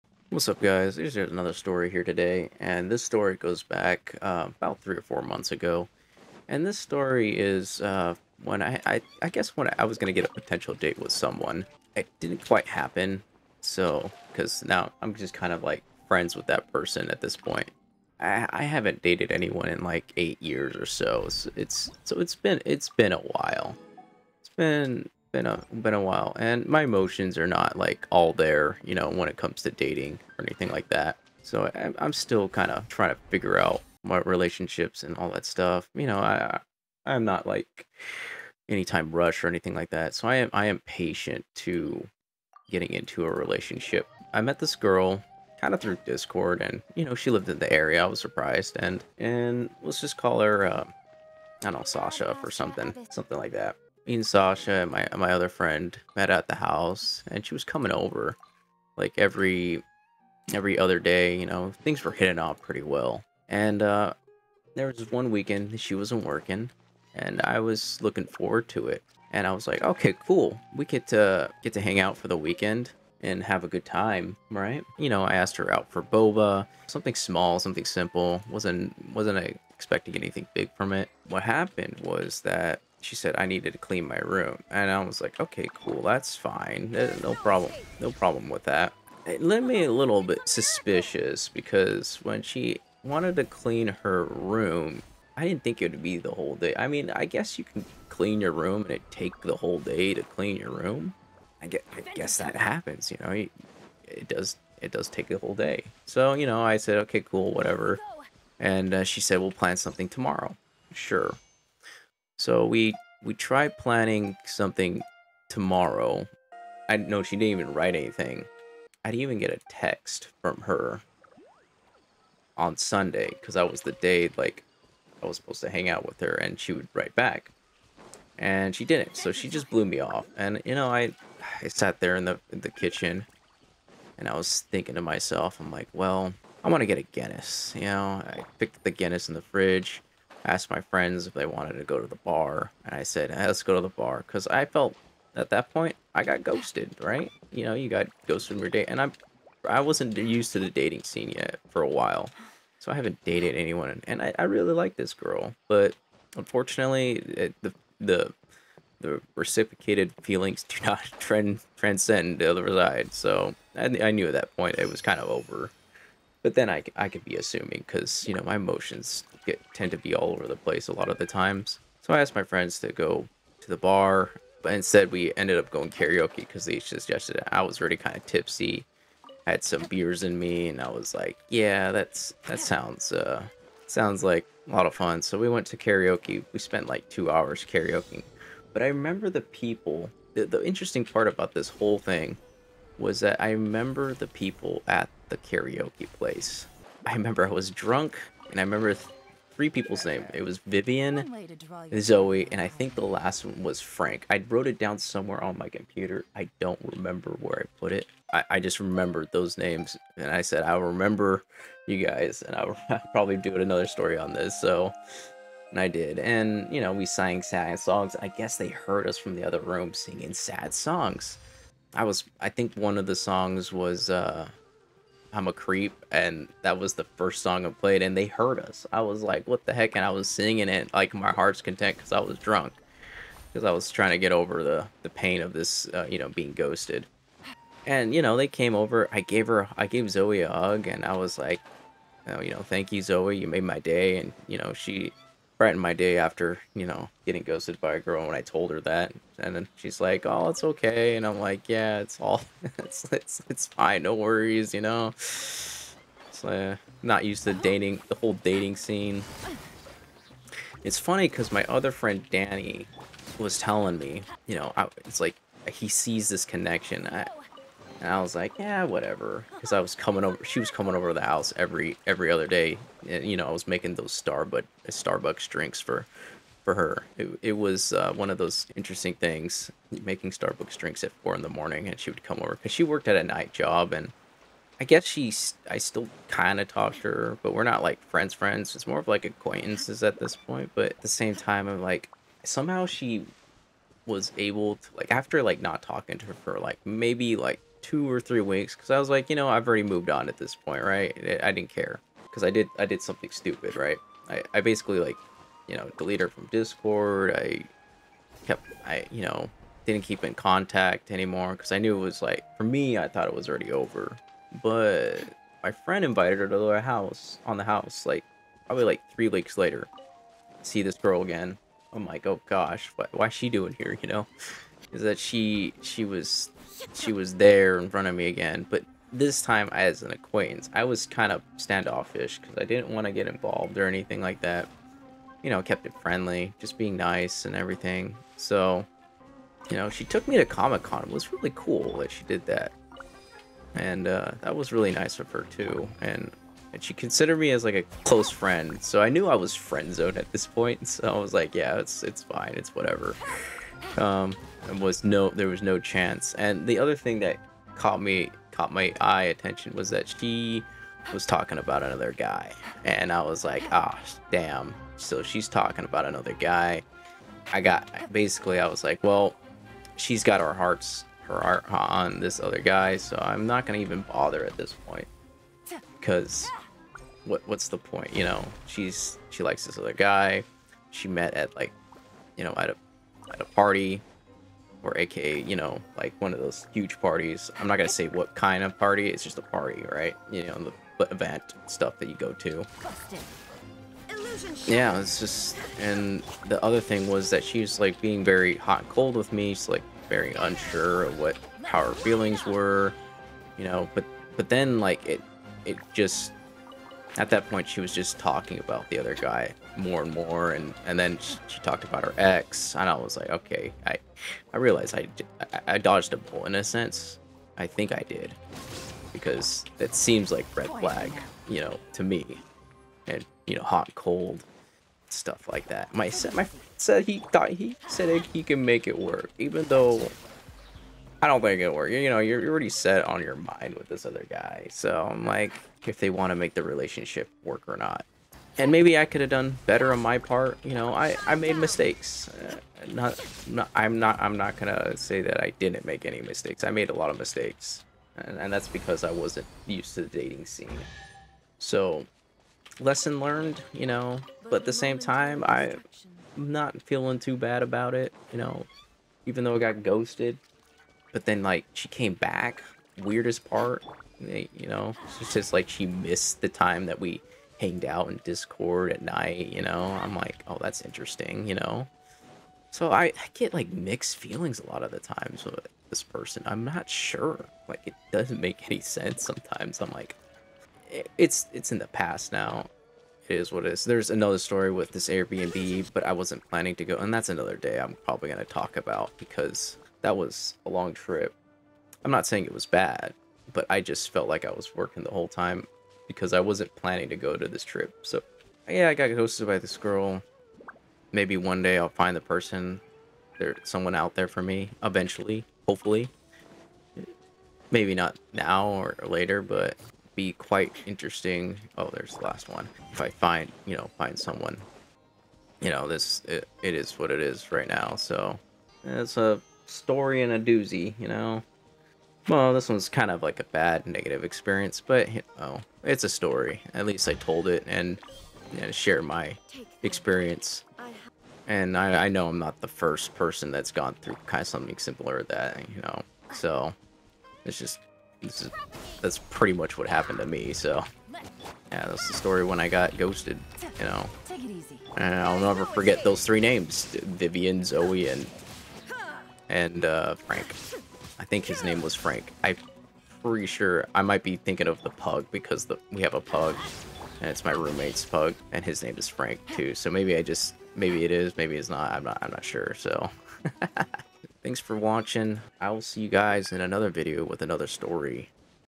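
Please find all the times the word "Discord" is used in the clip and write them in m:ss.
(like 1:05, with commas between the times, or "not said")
0:46, 5:06, 7:48.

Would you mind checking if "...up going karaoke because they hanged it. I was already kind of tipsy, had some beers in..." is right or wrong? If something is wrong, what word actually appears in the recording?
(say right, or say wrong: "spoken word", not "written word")
wrong: "suggested", not "hanged".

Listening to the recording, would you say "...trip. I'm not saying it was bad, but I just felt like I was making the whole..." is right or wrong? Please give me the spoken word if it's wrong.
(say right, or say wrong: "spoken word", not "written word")
wrong: "working", not "making".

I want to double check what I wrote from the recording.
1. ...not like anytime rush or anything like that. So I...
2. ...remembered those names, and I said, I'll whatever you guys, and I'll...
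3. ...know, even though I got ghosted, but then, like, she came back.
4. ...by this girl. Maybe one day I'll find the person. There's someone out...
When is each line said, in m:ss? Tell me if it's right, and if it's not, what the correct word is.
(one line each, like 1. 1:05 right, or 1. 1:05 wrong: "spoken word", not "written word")
1. 0:37 right
2. 3:28 wrong: "remember", not "whatever"
3. 7:38 right
4. 8:19 right.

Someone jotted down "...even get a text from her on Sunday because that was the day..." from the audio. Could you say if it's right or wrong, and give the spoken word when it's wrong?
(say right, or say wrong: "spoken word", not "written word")
right.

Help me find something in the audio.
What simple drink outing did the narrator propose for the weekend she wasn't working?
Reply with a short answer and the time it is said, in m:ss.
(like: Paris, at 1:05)
boba, at 1:16.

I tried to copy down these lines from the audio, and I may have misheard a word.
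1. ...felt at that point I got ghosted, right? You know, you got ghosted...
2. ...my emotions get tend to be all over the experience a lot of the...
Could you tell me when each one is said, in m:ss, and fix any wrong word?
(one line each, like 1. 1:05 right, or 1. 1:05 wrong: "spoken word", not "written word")
1. 2:24 right
2. 2:48 wrong: "place", not "experience".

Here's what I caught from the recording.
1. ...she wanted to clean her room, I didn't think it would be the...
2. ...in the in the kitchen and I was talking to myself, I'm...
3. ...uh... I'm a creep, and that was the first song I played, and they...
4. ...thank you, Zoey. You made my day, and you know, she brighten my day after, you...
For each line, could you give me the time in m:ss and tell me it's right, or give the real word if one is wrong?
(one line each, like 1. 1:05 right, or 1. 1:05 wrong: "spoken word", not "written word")
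1. 1:32 right
2. 2:12 wrong: "thinking", not "talking"
3. 3:44 right
4. 4:02 right.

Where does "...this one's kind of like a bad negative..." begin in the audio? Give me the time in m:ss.
8:42.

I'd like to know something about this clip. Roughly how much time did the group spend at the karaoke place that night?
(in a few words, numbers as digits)
2 hours.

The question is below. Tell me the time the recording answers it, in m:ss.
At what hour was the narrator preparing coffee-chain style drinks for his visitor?
4:41.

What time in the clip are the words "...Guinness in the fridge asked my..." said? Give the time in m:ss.
2:18.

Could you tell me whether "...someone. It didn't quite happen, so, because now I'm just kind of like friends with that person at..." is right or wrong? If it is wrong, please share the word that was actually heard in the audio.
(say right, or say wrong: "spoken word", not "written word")
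right.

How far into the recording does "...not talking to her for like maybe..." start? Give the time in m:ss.
4:55.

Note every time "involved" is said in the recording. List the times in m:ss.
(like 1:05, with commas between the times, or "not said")
5:33.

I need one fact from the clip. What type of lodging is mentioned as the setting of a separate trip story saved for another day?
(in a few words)
Airbnb.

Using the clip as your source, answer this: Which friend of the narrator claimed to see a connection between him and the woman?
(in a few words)
Danny.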